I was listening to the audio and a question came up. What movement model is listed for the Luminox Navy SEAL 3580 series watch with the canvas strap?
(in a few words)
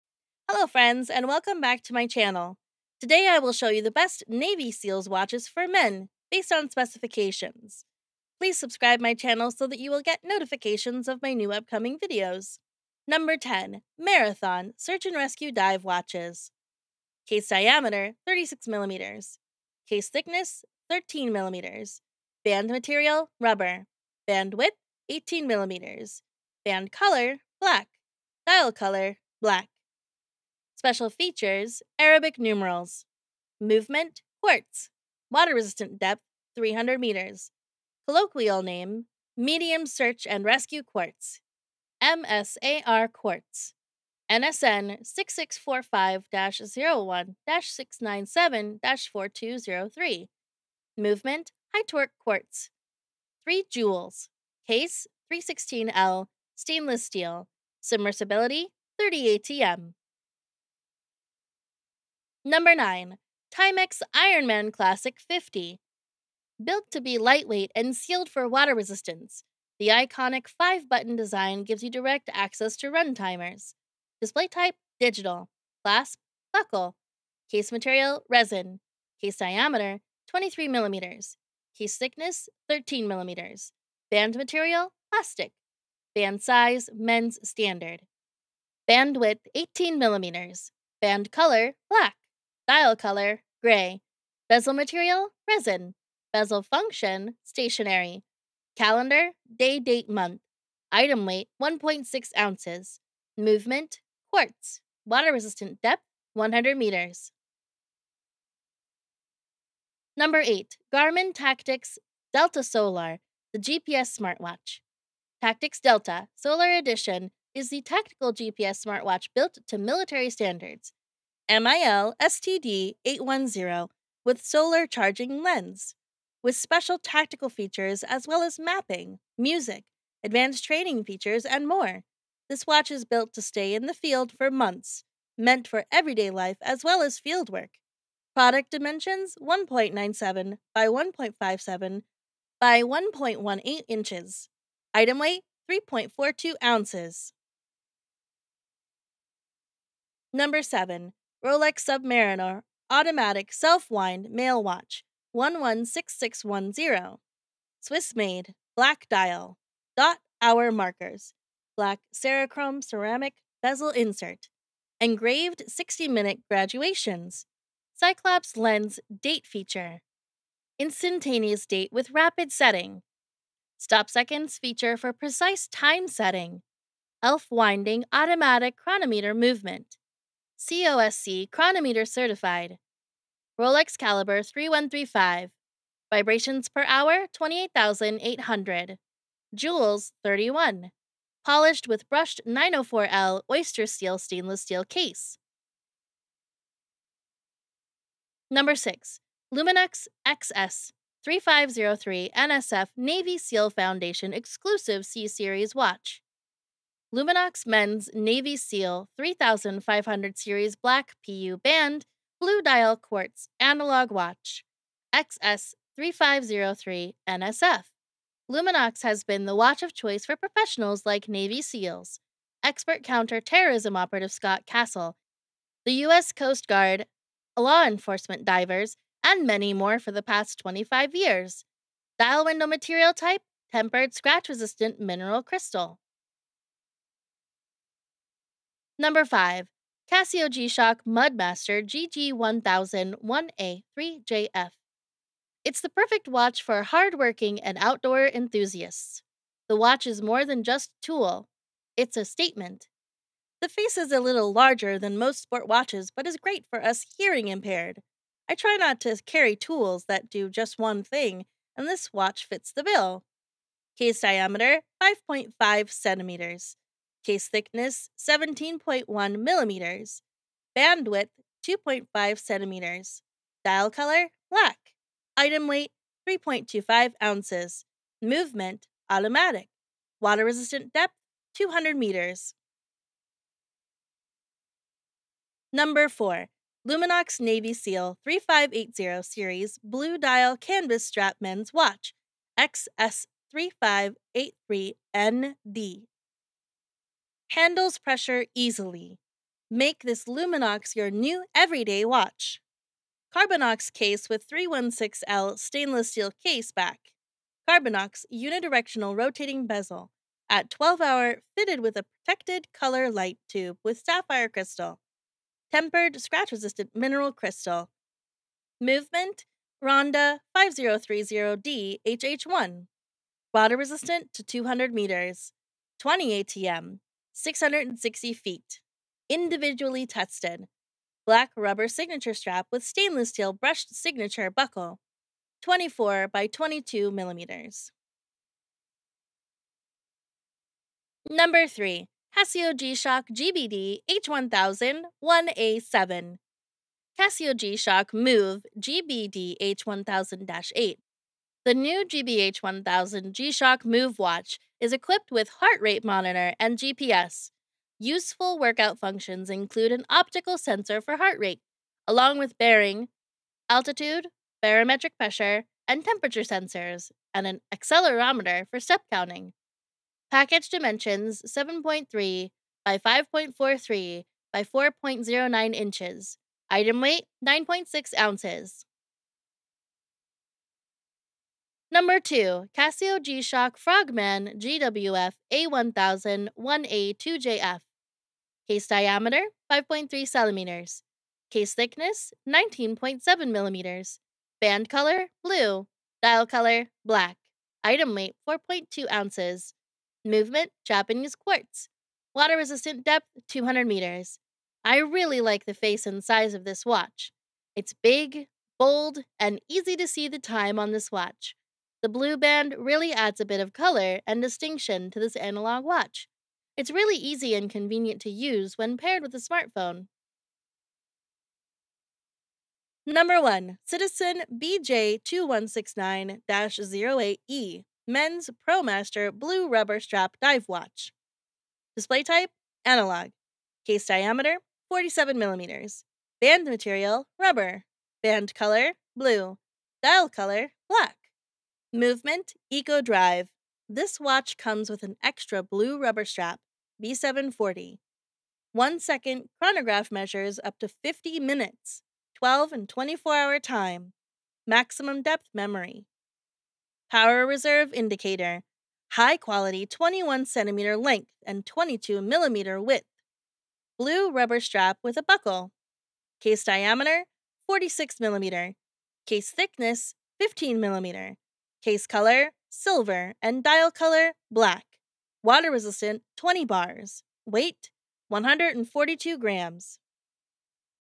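Ronda 5030D.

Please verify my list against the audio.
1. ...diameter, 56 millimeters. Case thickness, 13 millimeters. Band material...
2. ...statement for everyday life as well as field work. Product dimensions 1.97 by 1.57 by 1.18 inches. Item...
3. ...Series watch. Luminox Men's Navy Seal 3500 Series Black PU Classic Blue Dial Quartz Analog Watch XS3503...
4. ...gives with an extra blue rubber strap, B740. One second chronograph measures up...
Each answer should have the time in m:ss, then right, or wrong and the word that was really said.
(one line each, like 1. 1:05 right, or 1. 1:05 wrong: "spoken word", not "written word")
1. 0:17 wrong: "36", not "56"
2. 2:15 wrong: "meant", not "statement"
3. 3:25 wrong: "Band", not "Classic"
4. 7:24 wrong: "comes", not "gives".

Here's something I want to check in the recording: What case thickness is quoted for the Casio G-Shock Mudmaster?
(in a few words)
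17.1 millimeters.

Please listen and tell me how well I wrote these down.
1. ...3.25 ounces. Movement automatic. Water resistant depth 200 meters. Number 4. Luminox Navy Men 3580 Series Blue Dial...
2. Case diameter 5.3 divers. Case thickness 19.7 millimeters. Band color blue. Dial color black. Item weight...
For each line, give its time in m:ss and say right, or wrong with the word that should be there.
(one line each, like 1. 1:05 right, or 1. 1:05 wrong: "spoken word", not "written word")
1. 4:36 wrong: "SEAL", not "Men"
2. 6:28 wrong: "centimeters", not "divers".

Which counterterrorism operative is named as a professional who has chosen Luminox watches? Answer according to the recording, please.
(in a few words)
Scott Castle.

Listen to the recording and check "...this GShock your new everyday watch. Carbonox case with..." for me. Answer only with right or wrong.
wrong.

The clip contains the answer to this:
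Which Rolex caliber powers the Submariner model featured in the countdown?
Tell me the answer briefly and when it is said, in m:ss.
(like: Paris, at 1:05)
3135, at 3:04.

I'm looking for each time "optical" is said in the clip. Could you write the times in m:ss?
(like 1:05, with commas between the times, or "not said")
6:00.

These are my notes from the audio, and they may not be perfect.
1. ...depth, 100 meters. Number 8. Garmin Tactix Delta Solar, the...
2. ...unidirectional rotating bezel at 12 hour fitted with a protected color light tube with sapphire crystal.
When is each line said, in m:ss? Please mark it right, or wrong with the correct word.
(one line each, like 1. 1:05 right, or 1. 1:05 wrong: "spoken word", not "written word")
1. 1:45 right
2. 5:08 right.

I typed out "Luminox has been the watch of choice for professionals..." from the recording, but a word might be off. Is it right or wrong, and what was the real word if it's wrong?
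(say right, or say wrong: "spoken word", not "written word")
right.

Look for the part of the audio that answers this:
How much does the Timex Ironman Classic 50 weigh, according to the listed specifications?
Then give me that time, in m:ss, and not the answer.
1:41.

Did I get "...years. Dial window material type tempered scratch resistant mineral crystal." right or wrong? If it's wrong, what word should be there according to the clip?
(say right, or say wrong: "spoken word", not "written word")
right.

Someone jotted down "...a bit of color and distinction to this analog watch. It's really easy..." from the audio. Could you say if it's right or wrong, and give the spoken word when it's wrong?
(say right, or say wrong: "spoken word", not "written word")
right.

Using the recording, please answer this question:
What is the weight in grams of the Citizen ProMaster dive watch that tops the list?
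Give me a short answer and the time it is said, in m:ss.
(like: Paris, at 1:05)
142 grams, at 7:58.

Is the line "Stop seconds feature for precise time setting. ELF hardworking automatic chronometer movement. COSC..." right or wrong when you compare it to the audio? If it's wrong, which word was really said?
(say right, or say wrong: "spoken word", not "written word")
wrong: "winding", not "hardworking".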